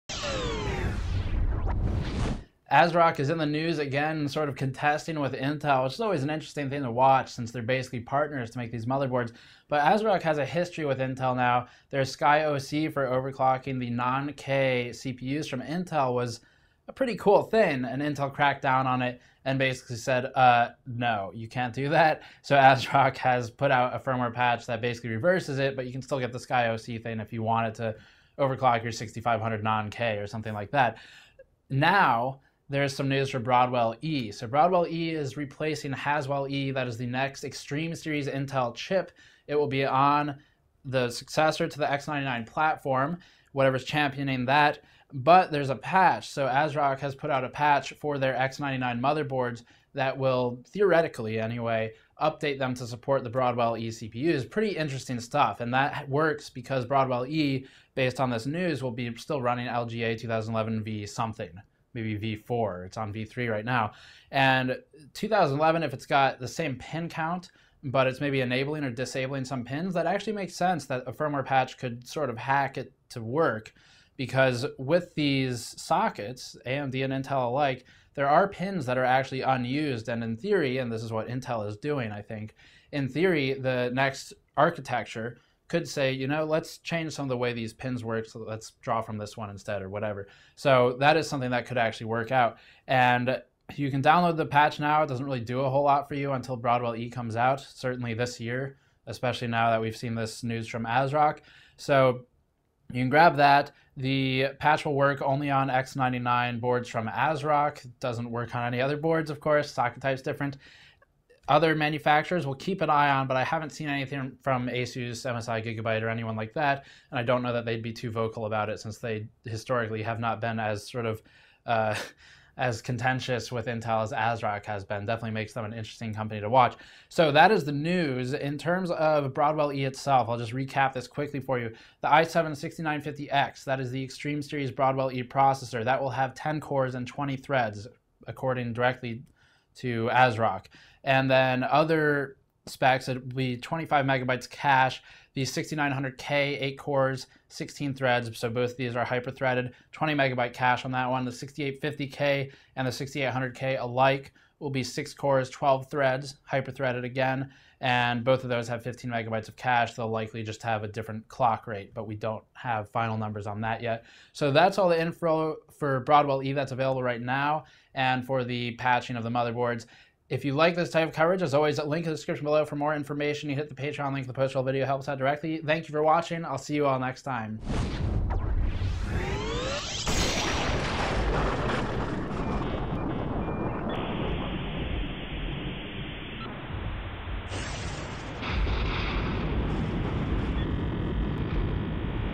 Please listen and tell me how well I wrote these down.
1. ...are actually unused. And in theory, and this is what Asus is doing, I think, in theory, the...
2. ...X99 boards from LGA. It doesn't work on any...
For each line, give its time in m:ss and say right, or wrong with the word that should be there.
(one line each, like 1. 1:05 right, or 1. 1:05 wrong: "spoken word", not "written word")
1. 1:18 wrong: "Intel", not "Asus"
2. 1:45 wrong: "ASRock", not "LGA".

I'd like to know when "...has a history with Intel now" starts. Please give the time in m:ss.
0:10.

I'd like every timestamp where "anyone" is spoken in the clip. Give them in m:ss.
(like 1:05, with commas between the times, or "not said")
1:56.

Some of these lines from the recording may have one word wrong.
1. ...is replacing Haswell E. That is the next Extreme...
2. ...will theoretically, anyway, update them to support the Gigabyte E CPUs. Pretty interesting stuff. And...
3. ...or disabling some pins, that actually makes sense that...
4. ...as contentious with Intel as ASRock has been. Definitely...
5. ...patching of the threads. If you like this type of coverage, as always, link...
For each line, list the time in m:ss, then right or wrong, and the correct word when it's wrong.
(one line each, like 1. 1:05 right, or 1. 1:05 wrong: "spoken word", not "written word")
1. 0:35 right
2. 0:50 wrong: "Broadwell", not "Gigabyte"
3. 1:08 right
4. 2:02 right
5. 2:48 wrong: "motherboards", not "threads".